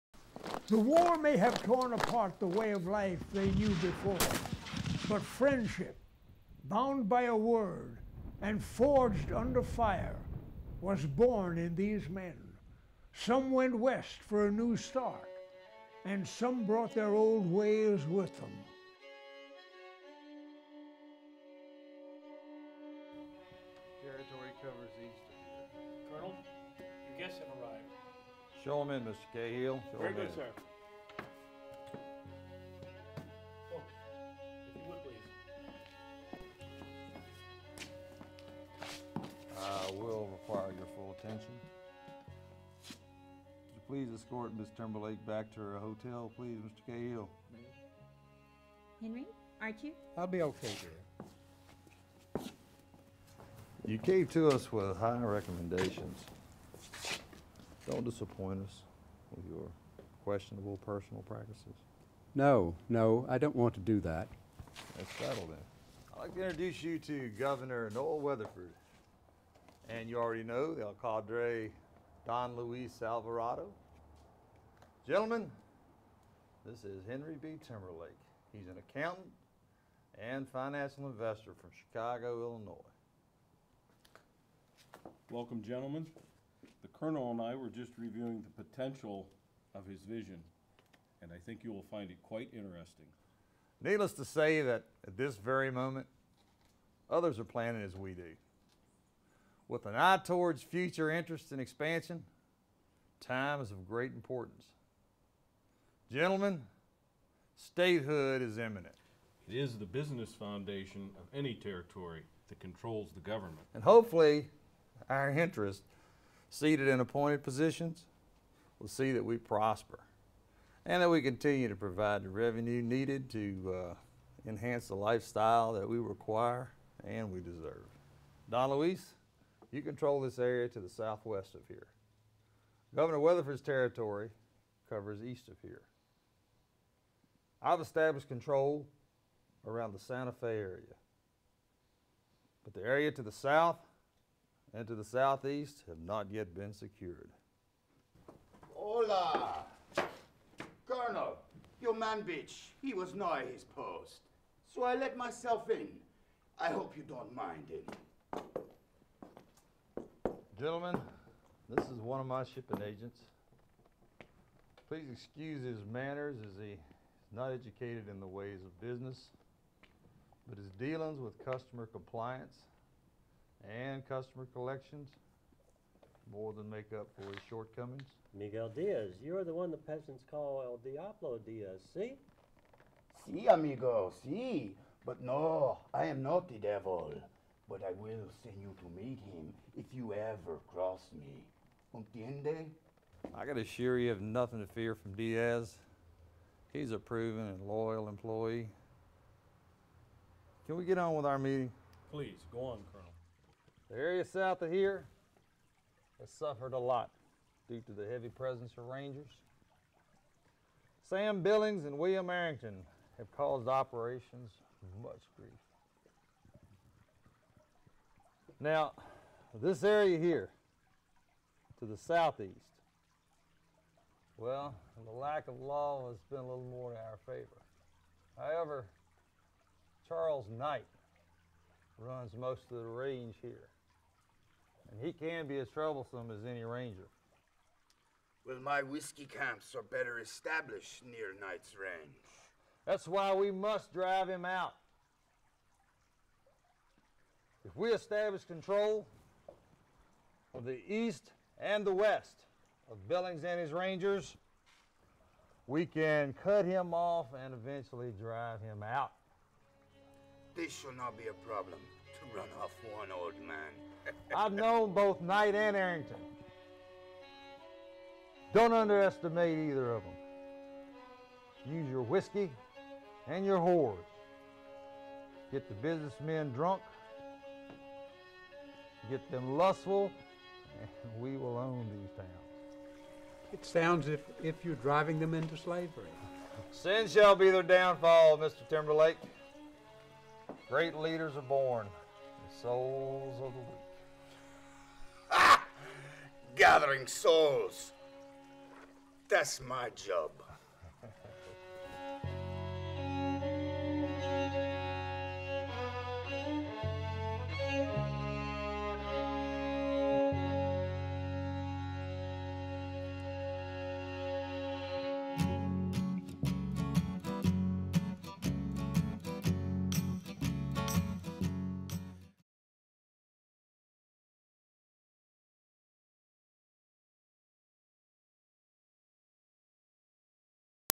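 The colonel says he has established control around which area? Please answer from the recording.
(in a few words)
Santa Fe.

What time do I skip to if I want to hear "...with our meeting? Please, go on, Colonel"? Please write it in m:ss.
3:21.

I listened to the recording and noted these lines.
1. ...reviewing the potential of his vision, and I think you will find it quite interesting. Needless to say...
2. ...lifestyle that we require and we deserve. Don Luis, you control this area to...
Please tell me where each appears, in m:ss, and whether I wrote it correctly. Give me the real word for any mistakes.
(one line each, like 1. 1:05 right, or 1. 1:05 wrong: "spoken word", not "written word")
1. 1:27 right
2. 2:04 right.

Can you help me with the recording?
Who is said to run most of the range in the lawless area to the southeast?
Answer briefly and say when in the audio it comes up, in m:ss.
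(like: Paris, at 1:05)
Charles Knight, at 3:50.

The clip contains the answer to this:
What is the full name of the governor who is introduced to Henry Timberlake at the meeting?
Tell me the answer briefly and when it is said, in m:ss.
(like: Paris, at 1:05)
Noah Weatherford, at 1:07.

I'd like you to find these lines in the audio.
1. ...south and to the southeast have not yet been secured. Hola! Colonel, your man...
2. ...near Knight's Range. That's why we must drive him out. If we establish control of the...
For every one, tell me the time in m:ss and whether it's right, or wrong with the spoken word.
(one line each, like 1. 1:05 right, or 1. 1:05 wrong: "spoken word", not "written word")
1. 2:23 right
2. 4:01 right.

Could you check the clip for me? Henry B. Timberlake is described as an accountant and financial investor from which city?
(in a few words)
Chicago.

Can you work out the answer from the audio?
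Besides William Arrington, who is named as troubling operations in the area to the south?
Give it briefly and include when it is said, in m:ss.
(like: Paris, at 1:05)
Sam Billings, at 3:31.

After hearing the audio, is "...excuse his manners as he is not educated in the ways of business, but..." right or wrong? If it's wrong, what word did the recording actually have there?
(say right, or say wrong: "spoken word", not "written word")
right.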